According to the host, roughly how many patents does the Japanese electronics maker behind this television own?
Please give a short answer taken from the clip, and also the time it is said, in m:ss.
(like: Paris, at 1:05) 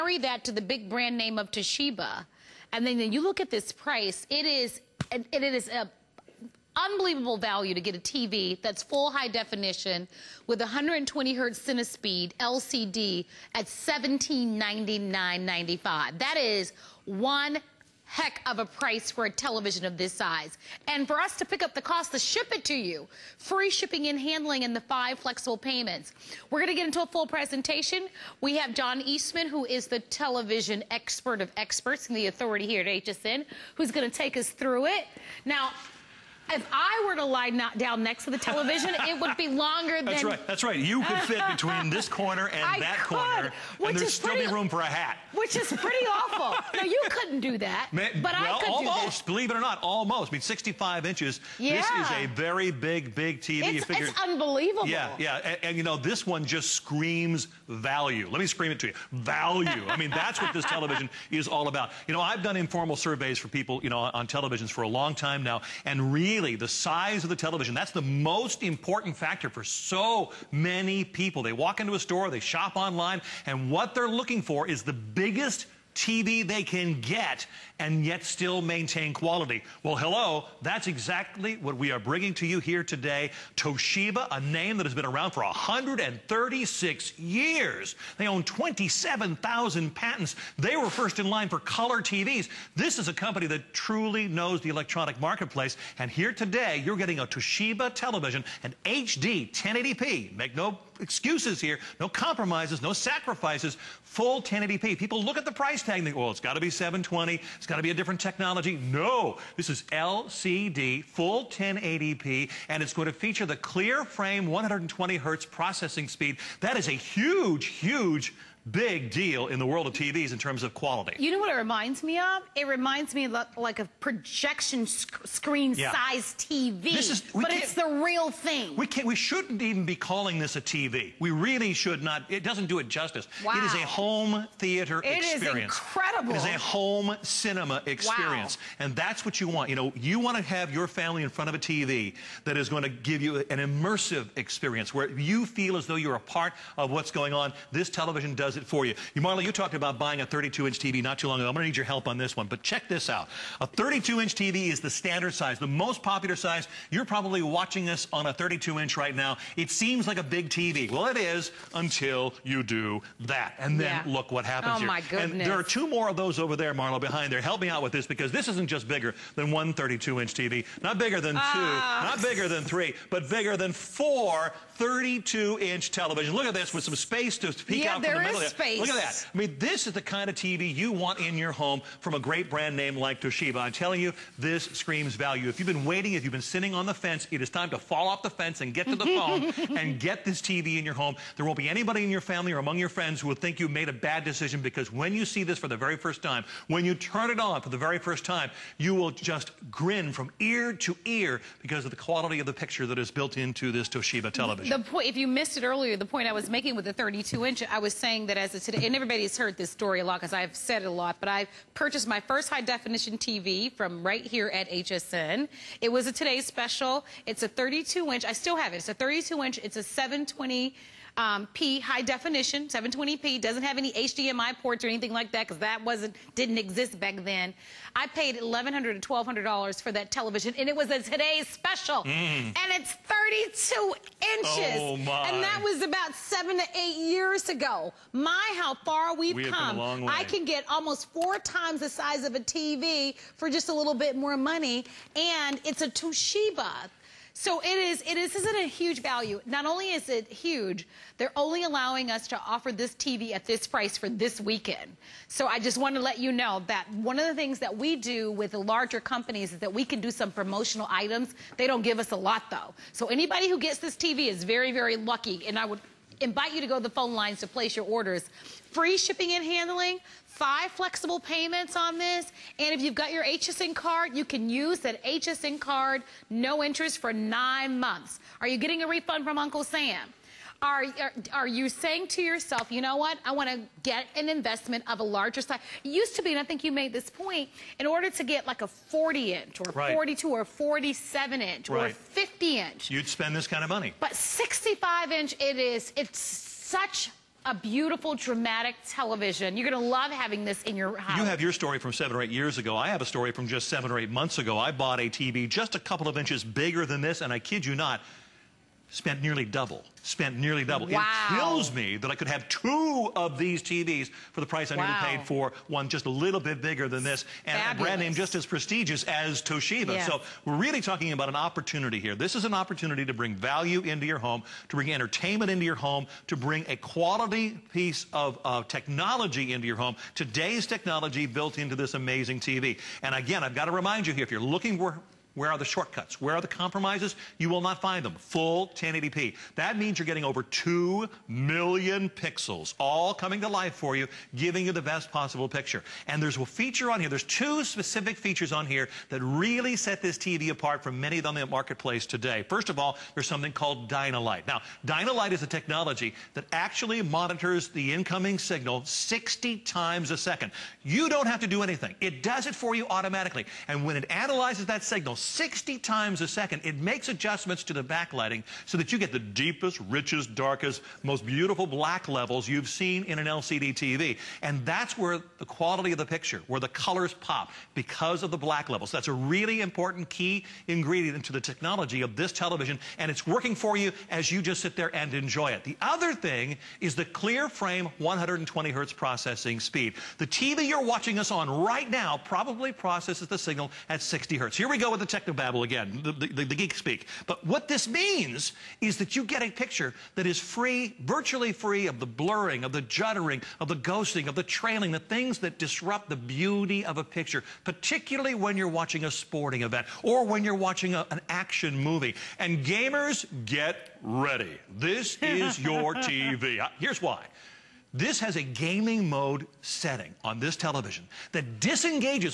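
27,000, at 1:28.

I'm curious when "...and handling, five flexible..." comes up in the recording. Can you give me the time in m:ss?
4:29.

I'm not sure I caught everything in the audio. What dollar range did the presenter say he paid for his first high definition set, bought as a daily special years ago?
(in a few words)
$1,100 to $1,200.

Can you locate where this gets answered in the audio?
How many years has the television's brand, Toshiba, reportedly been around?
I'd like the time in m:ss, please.
1:25.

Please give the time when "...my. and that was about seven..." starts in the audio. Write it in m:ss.
3:54.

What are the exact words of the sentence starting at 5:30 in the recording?
Today's technology built into this amazing TV.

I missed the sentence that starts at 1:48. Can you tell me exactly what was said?
No, this is LCD, full 1080p, and it's going to feature the clear frame 120 hertz processing speed.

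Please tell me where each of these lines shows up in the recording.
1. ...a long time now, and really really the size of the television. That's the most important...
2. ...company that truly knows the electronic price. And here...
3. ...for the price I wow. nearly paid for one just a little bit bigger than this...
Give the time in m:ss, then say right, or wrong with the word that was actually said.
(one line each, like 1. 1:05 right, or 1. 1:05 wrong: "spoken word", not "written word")
1. 1:04 right
2. 1:33 wrong: "marketplace", not "price"
3. 5:14 right.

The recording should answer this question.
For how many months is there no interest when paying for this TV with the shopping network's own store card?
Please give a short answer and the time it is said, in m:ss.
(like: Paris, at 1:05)
9, at 4:37.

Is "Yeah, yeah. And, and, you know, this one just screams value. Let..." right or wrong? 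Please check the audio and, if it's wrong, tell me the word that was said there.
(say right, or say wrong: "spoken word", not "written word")
right.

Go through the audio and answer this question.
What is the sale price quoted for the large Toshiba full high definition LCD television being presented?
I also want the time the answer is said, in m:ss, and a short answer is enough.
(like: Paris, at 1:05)
$1799.95, at 0:13.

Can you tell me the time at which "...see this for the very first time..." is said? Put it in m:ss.
3:15.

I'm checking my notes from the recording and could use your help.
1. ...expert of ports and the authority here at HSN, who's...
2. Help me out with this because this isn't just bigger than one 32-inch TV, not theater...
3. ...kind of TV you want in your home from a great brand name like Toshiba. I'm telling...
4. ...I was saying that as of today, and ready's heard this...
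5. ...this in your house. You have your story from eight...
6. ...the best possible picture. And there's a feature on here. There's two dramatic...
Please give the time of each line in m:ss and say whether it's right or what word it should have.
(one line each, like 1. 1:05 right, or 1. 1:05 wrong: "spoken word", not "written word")
1. 0:30 wrong: "experts", not "ports"
2. 2:47 wrong: "bigger", not "theater"
3. 3:00 right
4. 3:27 wrong: "everybody", not "ready"
5. 5:00 wrong: "seven", not "eight"
6. 5:44 wrong: "specific", not "dramatic".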